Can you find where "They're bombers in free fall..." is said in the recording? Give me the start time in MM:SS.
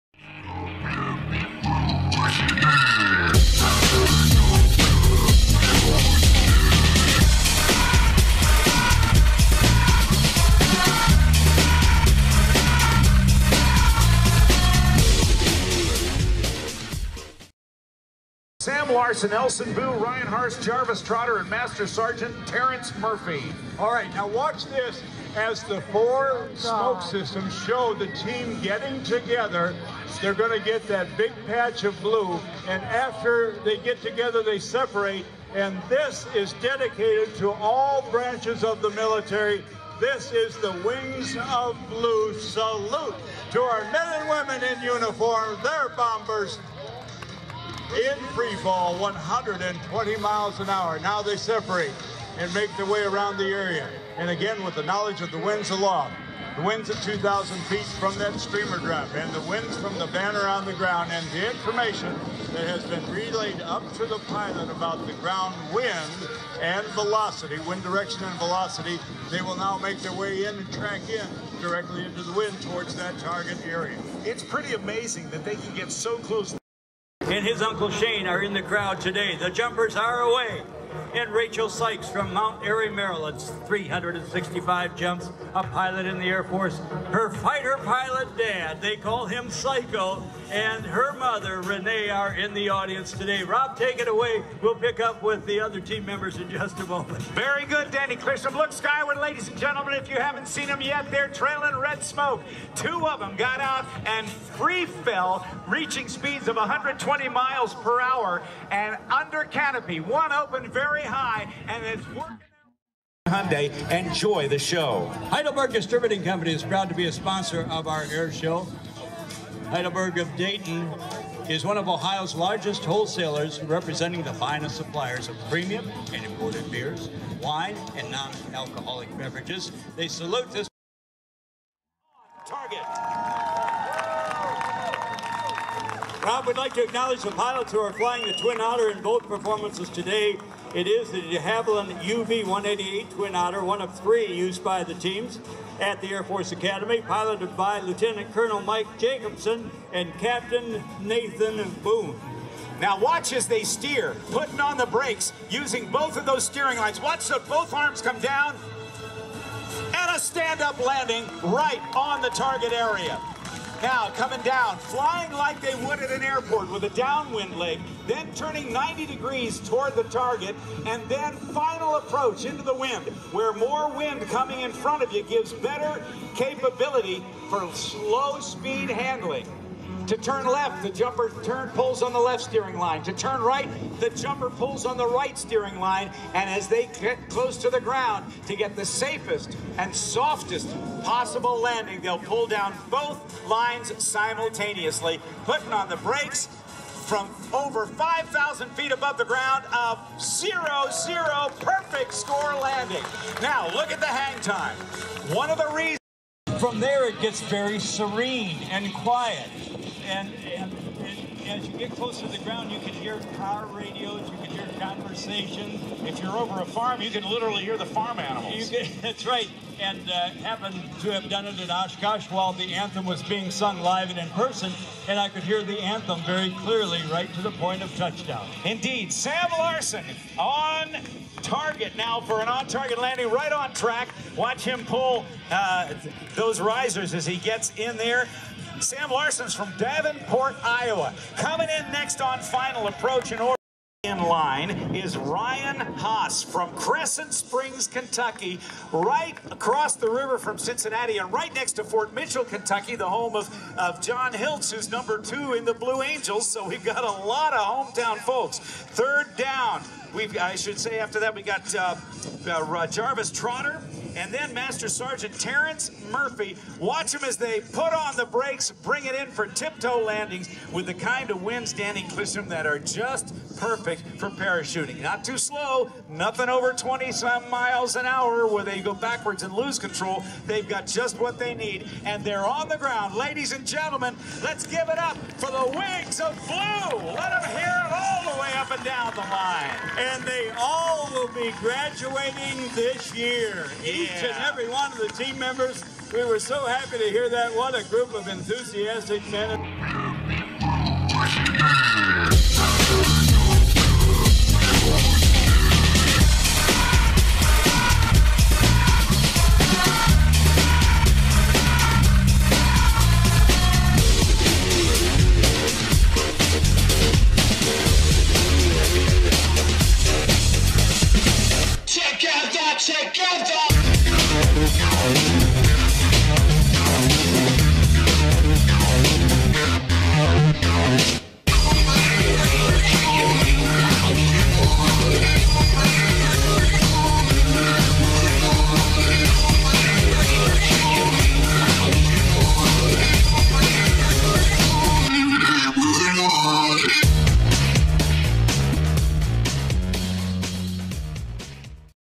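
00:45.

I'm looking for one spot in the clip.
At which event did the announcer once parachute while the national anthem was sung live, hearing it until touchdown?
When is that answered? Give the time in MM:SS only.
03:41.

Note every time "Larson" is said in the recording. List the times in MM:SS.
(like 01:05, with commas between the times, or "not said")
00:18, 03:49, 03:59.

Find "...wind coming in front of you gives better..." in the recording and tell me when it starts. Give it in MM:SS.
02:53.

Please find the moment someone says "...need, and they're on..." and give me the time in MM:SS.
04:41.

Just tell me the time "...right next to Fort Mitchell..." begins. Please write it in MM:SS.
04:11.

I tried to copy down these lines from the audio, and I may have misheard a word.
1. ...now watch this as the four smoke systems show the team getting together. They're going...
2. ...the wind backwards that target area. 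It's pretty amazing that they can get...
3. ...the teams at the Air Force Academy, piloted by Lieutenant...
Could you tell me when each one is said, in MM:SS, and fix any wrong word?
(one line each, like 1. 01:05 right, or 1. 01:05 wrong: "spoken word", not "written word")
1. 00:24 right
2. 01:12 wrong: "towards", not "backwards"
3. 02:24 right.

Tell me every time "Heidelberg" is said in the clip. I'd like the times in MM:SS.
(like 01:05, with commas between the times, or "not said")
01:55, 01:59.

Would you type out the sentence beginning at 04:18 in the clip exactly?
Third down, We've, I should say after that, we got uh, uh, uh, Jarvis Trotter and then Master Sergeant Terrence Murphy.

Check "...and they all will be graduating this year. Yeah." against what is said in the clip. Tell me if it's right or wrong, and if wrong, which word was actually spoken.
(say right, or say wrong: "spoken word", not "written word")
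right.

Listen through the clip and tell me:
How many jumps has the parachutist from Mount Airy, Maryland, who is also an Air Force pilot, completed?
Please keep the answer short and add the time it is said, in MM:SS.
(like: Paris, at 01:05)
365, at 01:23.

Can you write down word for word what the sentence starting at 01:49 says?
One opened very very high, and it's working.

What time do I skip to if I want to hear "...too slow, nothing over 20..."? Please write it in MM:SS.
04:35.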